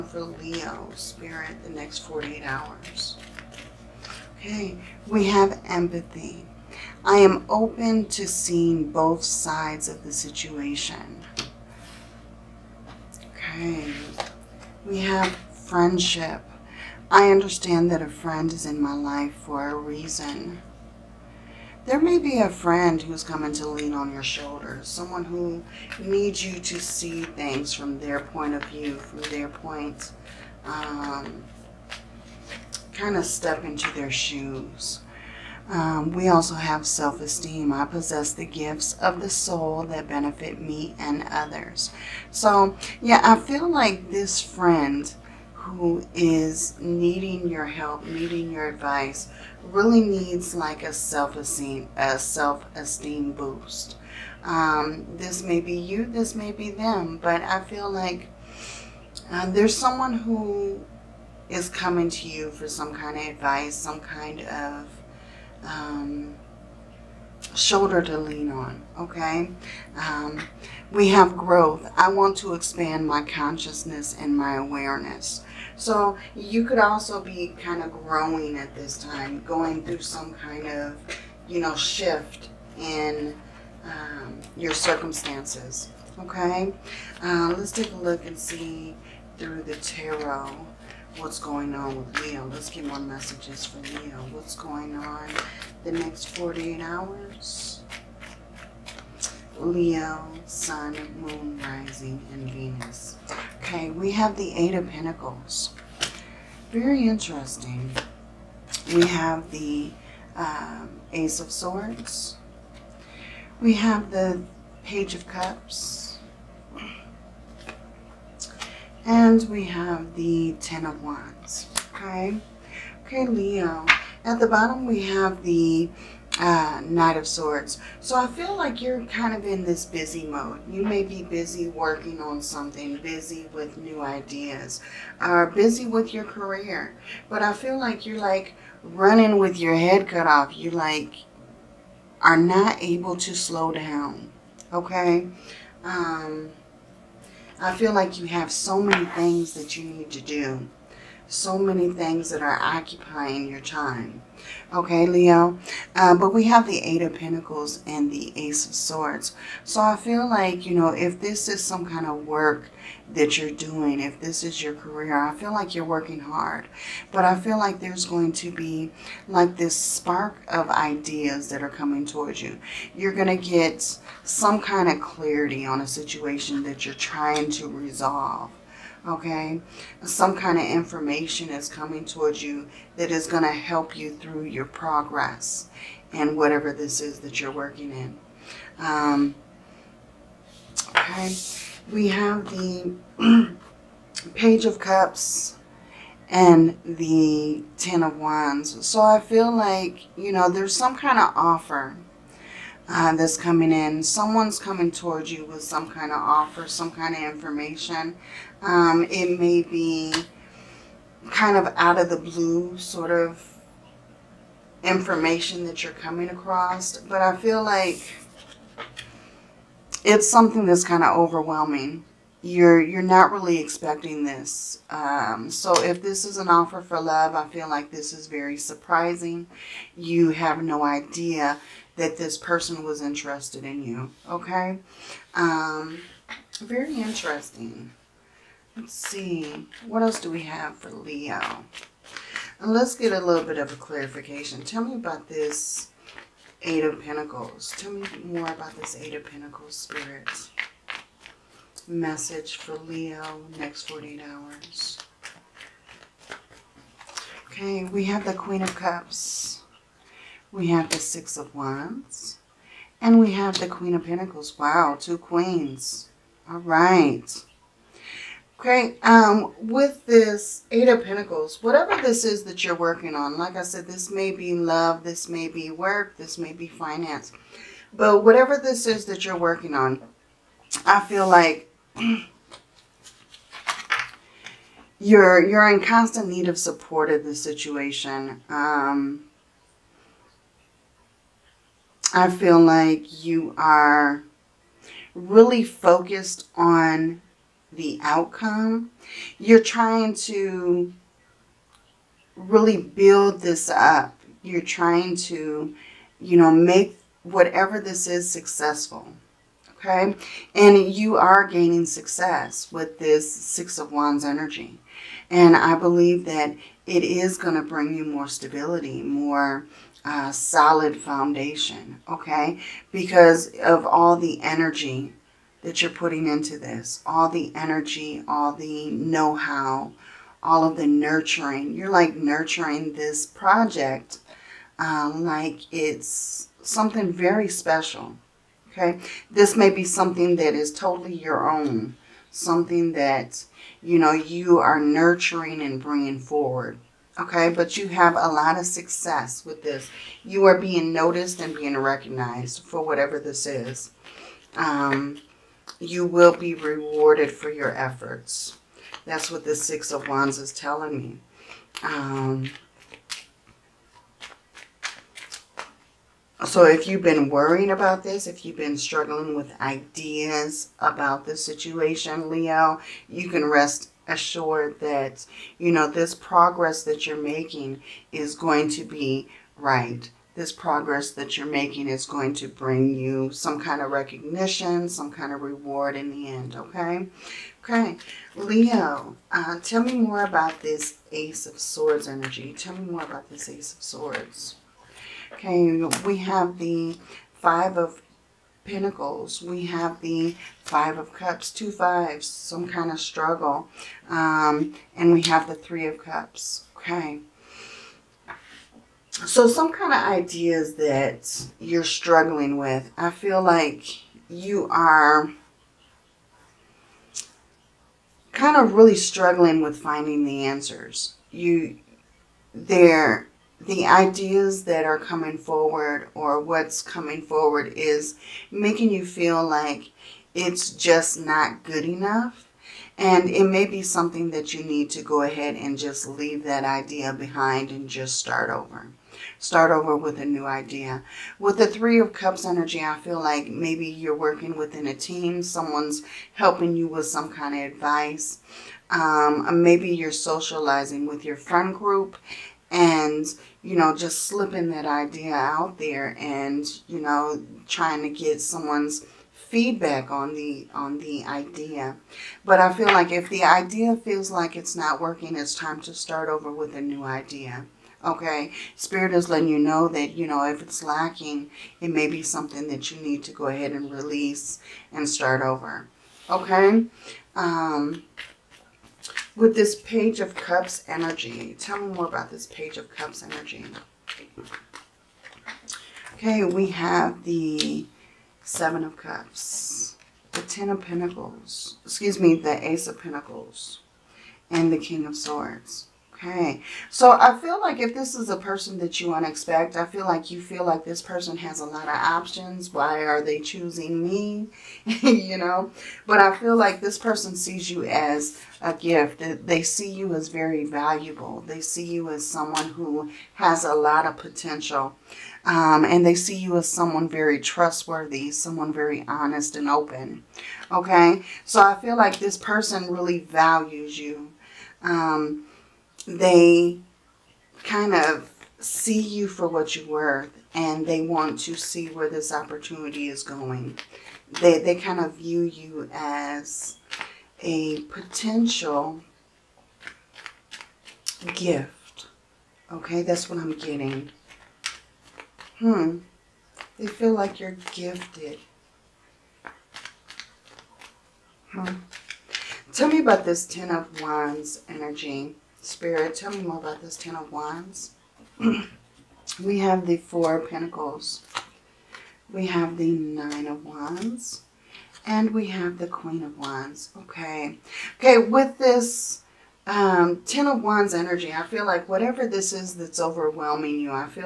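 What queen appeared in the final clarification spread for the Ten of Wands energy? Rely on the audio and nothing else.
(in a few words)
Queen of Wands.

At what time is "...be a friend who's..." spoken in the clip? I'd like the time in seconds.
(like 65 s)
22 s.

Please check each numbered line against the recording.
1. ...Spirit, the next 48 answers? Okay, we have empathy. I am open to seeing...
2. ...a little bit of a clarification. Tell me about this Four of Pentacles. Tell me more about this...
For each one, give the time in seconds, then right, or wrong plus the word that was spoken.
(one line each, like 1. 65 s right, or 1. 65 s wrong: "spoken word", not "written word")
1. 0 s wrong: "hours", not "answers"
2. 243 s wrong: "Eight", not "Four".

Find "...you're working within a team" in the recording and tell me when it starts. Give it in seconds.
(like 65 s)
443 s.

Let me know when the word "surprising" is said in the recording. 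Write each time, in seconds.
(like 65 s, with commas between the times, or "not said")
228 s.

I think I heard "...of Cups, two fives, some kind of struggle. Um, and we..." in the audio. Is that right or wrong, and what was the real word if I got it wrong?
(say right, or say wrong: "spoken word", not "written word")
right.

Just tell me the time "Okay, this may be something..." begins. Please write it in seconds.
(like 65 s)
338 s.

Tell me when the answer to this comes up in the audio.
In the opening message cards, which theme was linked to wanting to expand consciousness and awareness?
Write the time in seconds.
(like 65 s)
71 s.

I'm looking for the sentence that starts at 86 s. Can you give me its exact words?
Okay, uh, let's take a look and see through the tarot what's going on with Leo.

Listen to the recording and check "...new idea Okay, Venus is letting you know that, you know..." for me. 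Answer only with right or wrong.
wrong.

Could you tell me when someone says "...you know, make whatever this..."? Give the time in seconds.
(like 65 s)
306 s.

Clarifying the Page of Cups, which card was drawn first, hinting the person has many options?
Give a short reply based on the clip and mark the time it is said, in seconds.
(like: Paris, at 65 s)
Seven of Cups, at 488 s.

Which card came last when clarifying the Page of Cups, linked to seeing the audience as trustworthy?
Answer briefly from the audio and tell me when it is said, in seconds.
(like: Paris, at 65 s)
King of Swords, at 494 s.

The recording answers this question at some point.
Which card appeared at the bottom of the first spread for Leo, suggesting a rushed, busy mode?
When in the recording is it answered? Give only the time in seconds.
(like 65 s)
126 s.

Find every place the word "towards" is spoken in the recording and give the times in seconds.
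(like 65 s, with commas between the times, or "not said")
172 s, 182 s, 204 s.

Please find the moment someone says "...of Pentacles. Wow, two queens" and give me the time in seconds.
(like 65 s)
263 s.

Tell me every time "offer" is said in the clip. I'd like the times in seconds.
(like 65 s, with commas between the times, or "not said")
201 s, 206 s, 226 s.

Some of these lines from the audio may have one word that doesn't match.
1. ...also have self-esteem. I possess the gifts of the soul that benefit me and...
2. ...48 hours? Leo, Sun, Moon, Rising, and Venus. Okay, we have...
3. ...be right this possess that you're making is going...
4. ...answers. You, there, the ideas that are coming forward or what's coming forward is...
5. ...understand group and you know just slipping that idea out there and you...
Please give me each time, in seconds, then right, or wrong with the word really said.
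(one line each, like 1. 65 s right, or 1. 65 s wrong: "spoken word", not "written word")
1. 36 s right
2. 96 s right
3. 378 s wrong: "progress", not "possess"
4. 420 s right
5. 451 s wrong: "friend", not "understand".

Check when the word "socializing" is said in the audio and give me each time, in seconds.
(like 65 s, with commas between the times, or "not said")
450 s.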